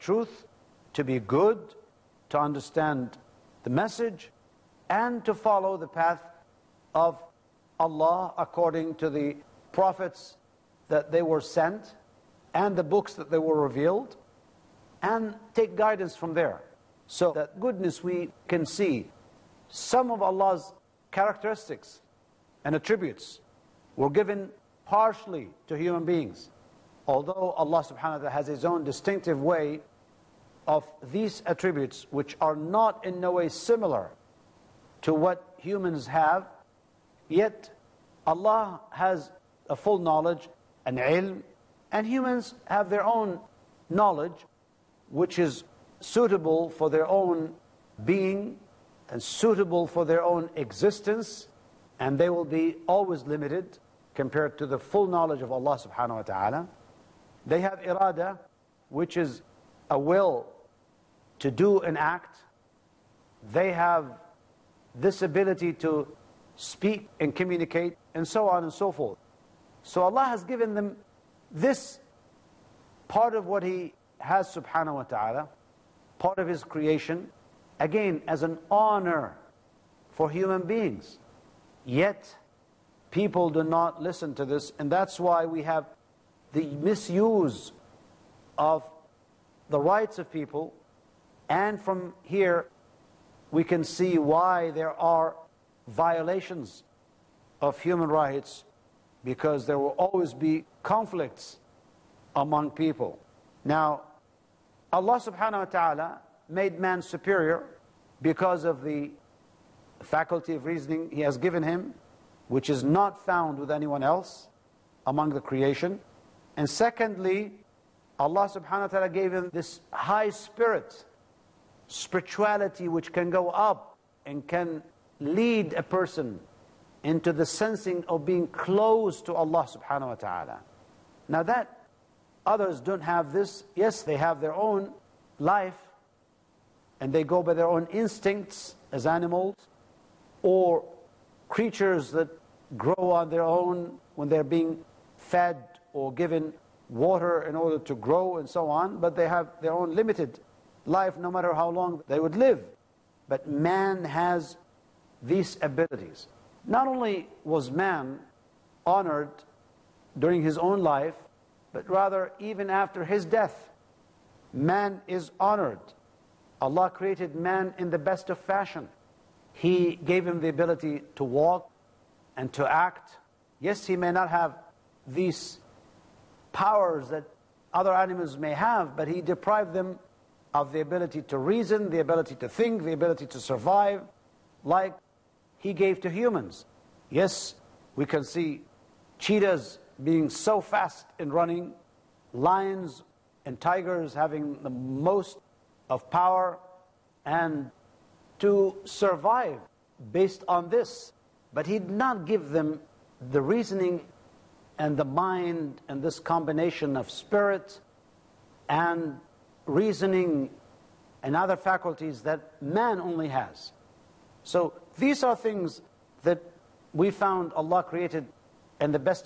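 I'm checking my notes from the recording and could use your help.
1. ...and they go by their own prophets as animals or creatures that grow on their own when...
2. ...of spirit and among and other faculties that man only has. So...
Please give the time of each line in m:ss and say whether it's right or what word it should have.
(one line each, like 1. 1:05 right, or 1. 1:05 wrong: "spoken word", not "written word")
1. 2:16 wrong: "instincts", not "prophets"
2. 3:26 wrong: "reasoning", not "among".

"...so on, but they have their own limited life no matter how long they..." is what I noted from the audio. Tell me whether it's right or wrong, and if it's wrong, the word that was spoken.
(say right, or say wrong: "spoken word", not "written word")
right.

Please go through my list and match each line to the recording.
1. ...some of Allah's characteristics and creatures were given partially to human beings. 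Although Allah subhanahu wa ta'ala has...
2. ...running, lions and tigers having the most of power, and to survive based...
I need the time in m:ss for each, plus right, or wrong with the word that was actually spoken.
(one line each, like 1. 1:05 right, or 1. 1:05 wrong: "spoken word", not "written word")
1. 0:19 wrong: "attributes", not "creatures"
2. 3:11 right.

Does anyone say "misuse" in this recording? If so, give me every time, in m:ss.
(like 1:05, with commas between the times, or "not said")
1:26.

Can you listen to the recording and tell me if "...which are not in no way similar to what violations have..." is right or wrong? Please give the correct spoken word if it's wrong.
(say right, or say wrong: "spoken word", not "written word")
wrong: "humans", not "violations".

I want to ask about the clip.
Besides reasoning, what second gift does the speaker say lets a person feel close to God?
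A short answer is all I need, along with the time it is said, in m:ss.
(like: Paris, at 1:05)
high spirit, at 1:59.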